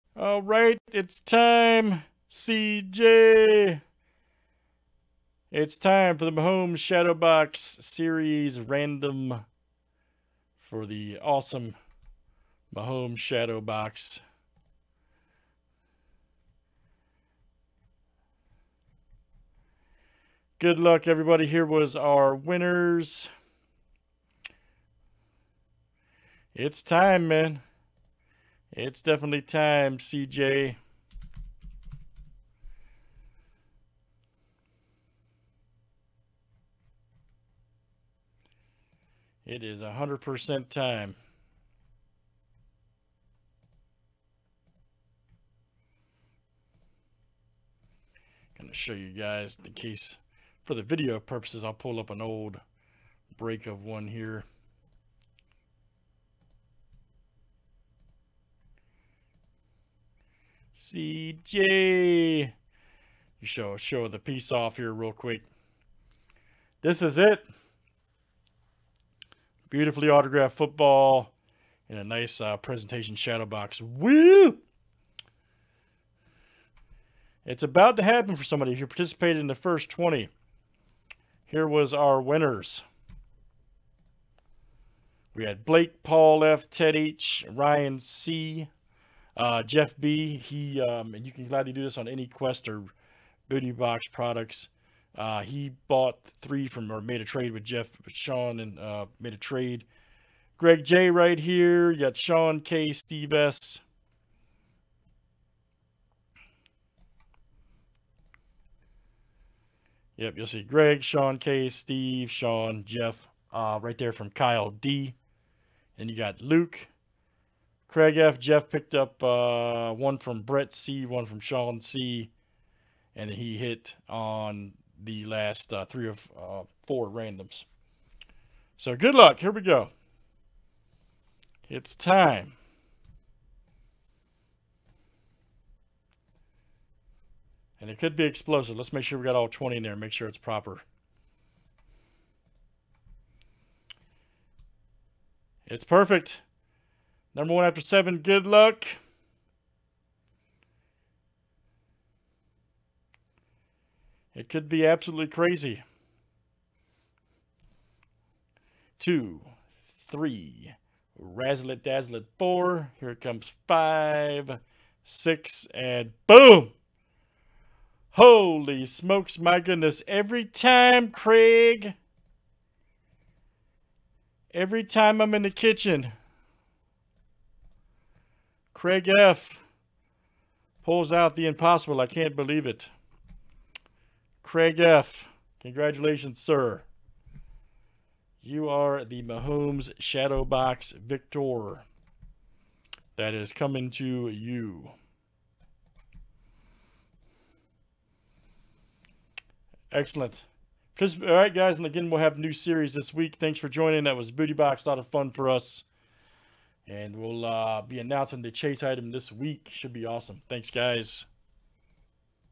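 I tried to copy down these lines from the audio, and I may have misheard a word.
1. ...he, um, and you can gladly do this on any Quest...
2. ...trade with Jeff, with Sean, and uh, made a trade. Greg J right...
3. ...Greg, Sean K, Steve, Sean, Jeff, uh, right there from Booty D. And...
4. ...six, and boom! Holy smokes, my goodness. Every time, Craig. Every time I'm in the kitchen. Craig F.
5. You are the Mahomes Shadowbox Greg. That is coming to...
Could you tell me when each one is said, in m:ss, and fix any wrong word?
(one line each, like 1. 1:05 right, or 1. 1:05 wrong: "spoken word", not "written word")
1. 1:30 right
2. 1:37 right
3. 1:50 wrong: "Kyle", not "Booty"
4. 2:45 right
5. 3:08 wrong: "Victor", not "Greg".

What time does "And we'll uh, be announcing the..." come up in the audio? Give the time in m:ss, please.
3:26.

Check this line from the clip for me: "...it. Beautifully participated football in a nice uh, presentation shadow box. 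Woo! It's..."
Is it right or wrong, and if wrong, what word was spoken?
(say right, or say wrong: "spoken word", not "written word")
wrong: "autographed", not "participated".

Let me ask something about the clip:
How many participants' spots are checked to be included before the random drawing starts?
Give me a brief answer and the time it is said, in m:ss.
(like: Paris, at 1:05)
20, at 2:19.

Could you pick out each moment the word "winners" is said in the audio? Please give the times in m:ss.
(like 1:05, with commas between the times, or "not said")
0:22, 1:22.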